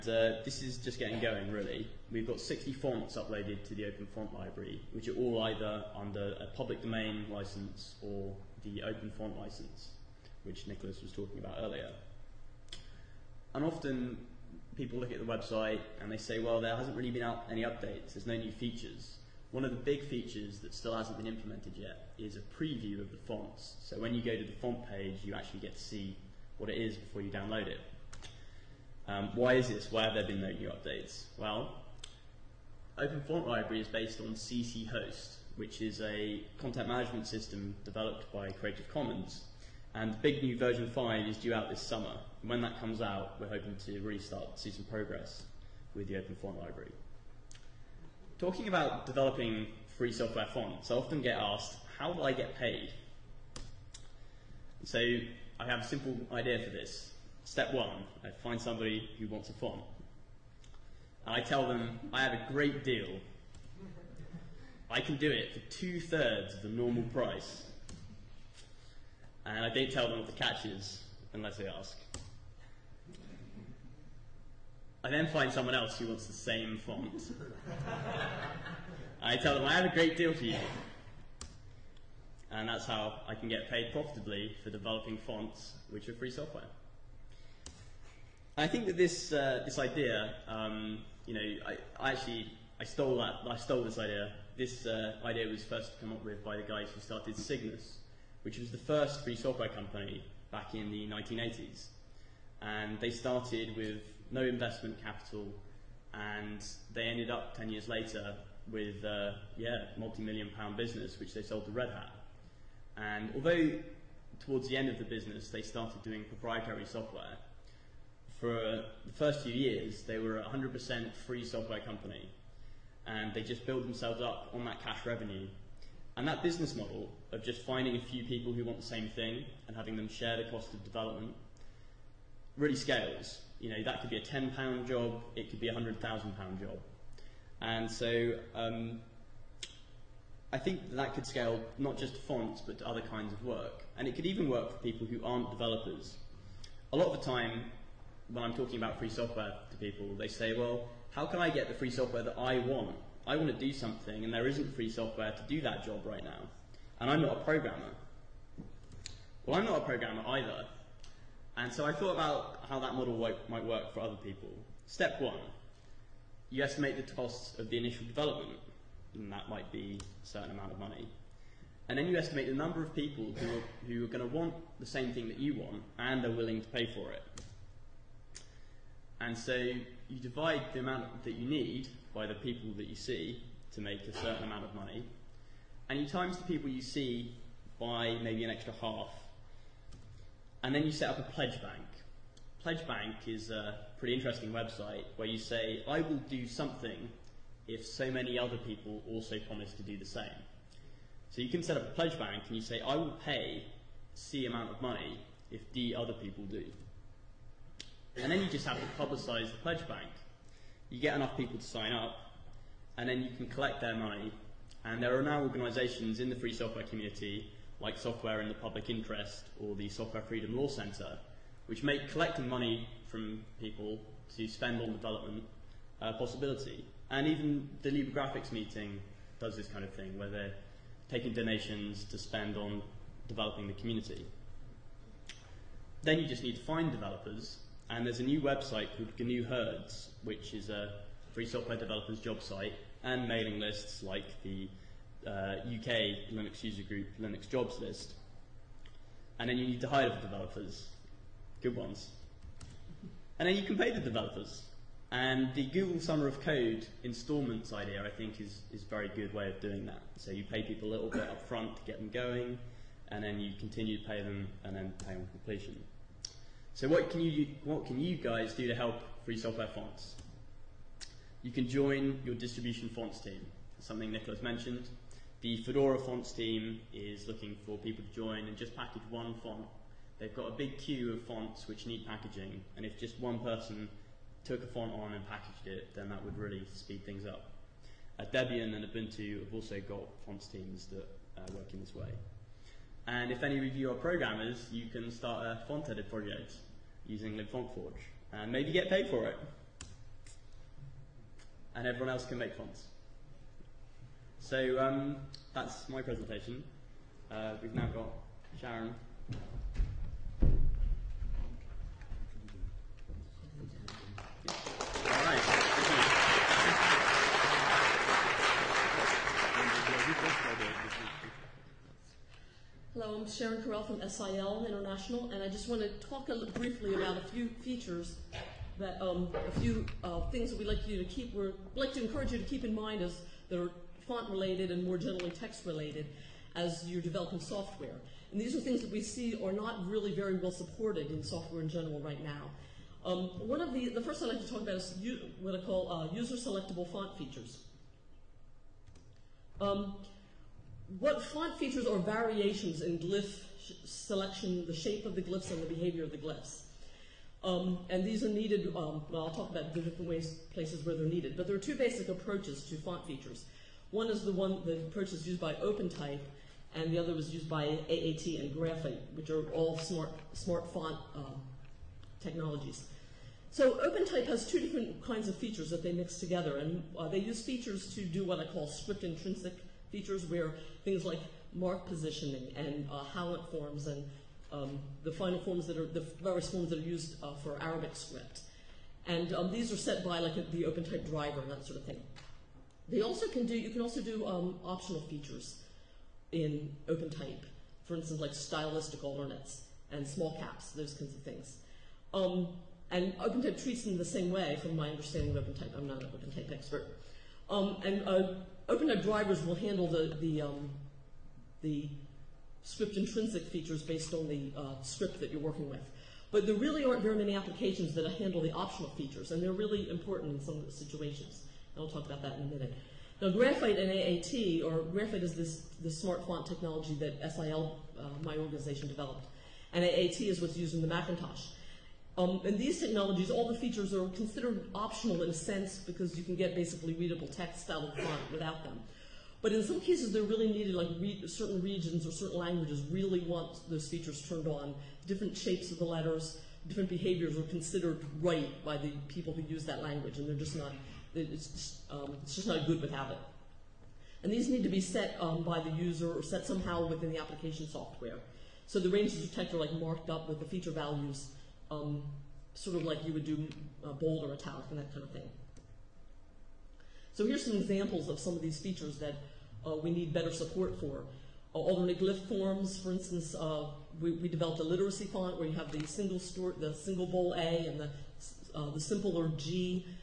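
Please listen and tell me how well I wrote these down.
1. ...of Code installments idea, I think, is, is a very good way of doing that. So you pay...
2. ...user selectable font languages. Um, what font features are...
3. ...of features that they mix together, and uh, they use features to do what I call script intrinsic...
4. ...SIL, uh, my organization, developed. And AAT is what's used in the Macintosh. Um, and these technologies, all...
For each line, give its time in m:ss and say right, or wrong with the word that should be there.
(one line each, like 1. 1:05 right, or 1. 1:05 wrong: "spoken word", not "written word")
1. 4:16 right
2. 5:46 wrong: "features", not "languages"
3. 6:15 right
4. 7:07 right.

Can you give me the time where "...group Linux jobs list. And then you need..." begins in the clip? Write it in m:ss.
4:06.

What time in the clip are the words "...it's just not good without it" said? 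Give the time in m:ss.
7:32.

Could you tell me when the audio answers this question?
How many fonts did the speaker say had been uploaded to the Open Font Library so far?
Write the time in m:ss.
0:02.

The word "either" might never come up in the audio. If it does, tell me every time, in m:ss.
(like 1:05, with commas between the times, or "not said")
0:05, 2:40.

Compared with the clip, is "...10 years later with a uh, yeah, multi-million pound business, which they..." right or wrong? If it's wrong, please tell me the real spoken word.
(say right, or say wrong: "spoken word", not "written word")
right.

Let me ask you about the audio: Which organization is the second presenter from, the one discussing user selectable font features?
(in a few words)
SIL International.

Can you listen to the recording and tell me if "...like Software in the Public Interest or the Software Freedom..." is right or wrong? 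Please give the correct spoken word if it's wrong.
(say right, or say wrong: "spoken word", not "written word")
right.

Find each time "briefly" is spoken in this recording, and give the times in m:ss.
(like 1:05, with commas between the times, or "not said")
5:26.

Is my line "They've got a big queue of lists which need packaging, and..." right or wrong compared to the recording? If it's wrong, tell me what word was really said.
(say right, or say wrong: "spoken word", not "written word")
wrong: "fonts", not "lists".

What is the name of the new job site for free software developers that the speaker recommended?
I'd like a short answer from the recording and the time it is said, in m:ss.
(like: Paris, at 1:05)
GNU Herds, at 3:59.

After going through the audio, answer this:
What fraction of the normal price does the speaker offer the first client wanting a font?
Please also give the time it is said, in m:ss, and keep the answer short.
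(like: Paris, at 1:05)
two thirds, at 1:05.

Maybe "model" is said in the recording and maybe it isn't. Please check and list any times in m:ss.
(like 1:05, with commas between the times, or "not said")
2:06, 2:42.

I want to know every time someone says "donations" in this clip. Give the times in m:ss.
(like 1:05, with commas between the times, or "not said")
3:51.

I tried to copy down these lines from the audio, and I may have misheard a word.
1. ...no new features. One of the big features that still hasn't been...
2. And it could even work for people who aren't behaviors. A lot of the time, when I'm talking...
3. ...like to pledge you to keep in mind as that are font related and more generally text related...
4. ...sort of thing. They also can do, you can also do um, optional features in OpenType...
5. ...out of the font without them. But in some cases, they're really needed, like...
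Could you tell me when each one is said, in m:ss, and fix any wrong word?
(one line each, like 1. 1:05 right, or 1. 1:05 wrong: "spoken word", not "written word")
1. 0:18 right
2. 2:23 wrong: "developers", not "behaviors"
3. 5:31 wrong: "encourage", not "pledge"
4. 6:31 right
5. 7:17 right.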